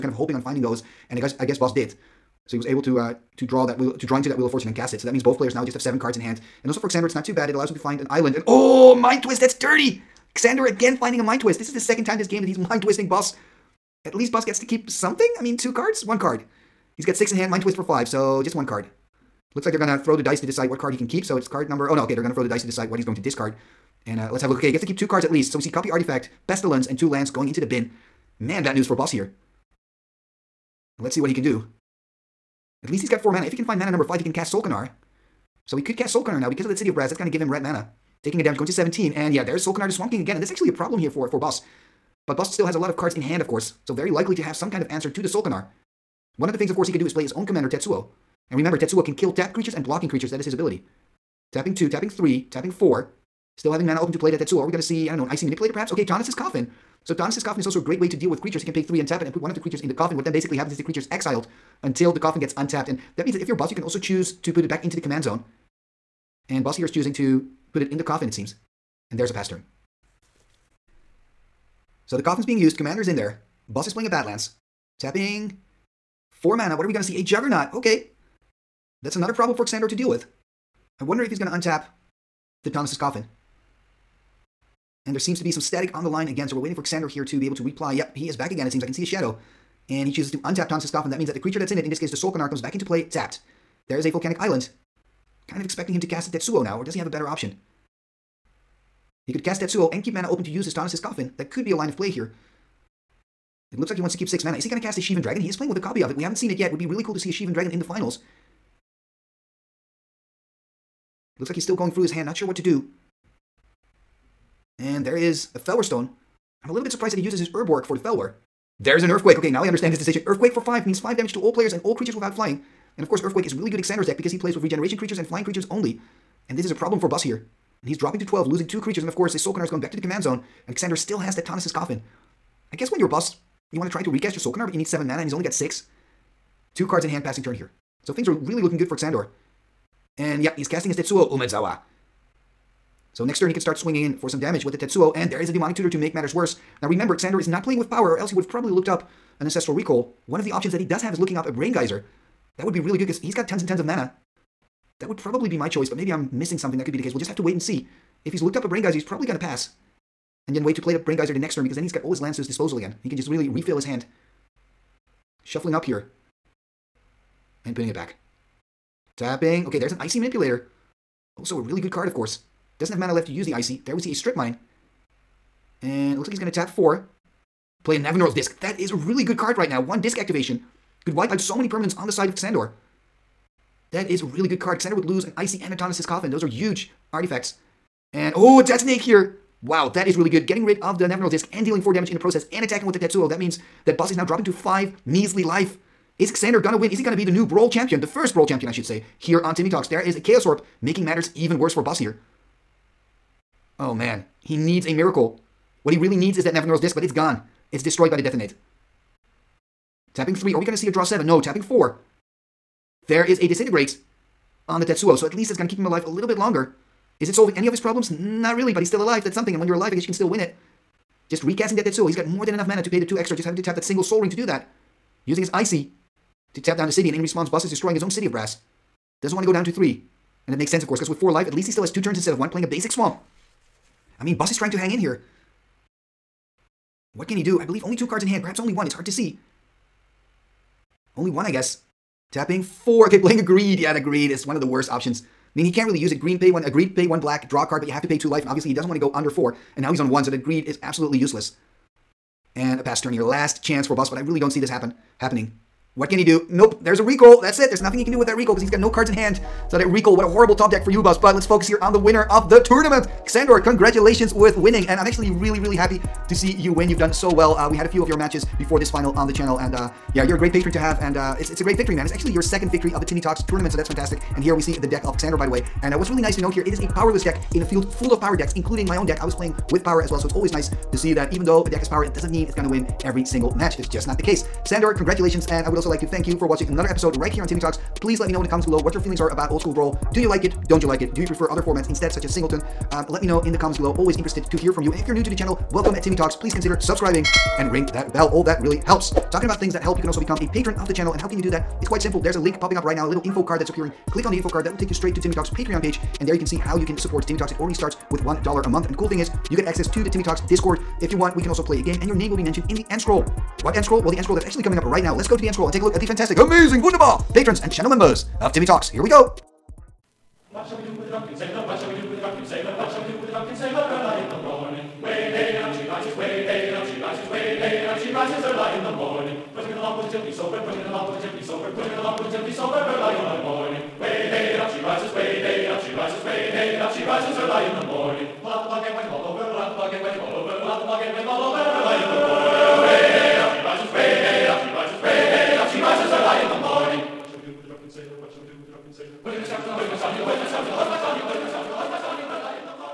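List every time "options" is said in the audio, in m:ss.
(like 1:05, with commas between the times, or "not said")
1:37, 2:30, 4:04.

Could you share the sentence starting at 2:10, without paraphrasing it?
And Xander still has that Tawnos' coffin.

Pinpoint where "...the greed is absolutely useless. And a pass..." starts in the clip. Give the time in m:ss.
4:10.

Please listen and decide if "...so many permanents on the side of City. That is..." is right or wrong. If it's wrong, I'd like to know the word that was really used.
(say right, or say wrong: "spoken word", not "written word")
wrong: "Xander", not "City".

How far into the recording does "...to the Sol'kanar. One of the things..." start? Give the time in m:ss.
0:45.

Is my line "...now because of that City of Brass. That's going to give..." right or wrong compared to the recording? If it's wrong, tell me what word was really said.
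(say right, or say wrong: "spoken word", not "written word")
right.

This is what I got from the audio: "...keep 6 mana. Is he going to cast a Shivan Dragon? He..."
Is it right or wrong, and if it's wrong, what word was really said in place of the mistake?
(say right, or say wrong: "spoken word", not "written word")
right.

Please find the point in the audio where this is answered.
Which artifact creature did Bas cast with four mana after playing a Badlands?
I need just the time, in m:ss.
1:17.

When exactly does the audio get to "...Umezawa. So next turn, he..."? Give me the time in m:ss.
2:21.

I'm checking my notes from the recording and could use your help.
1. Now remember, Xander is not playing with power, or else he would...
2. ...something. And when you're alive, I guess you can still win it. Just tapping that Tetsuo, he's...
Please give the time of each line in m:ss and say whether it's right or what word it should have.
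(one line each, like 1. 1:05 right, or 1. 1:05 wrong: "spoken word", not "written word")
1. 2:26 right
2. 3:39 wrong: "recasting", not "tapping".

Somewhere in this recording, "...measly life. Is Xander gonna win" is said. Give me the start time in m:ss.
3:15.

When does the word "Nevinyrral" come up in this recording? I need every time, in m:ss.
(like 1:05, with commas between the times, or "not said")
2:57, 3:11, 3:26.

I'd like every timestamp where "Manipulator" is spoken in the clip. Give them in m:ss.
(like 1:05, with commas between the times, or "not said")
0:55, 2:50.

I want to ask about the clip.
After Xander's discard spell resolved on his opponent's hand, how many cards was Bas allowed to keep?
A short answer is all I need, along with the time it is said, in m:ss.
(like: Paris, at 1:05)
2, at 0:24.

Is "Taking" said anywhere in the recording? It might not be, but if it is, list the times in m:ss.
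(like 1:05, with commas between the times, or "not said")
0:38.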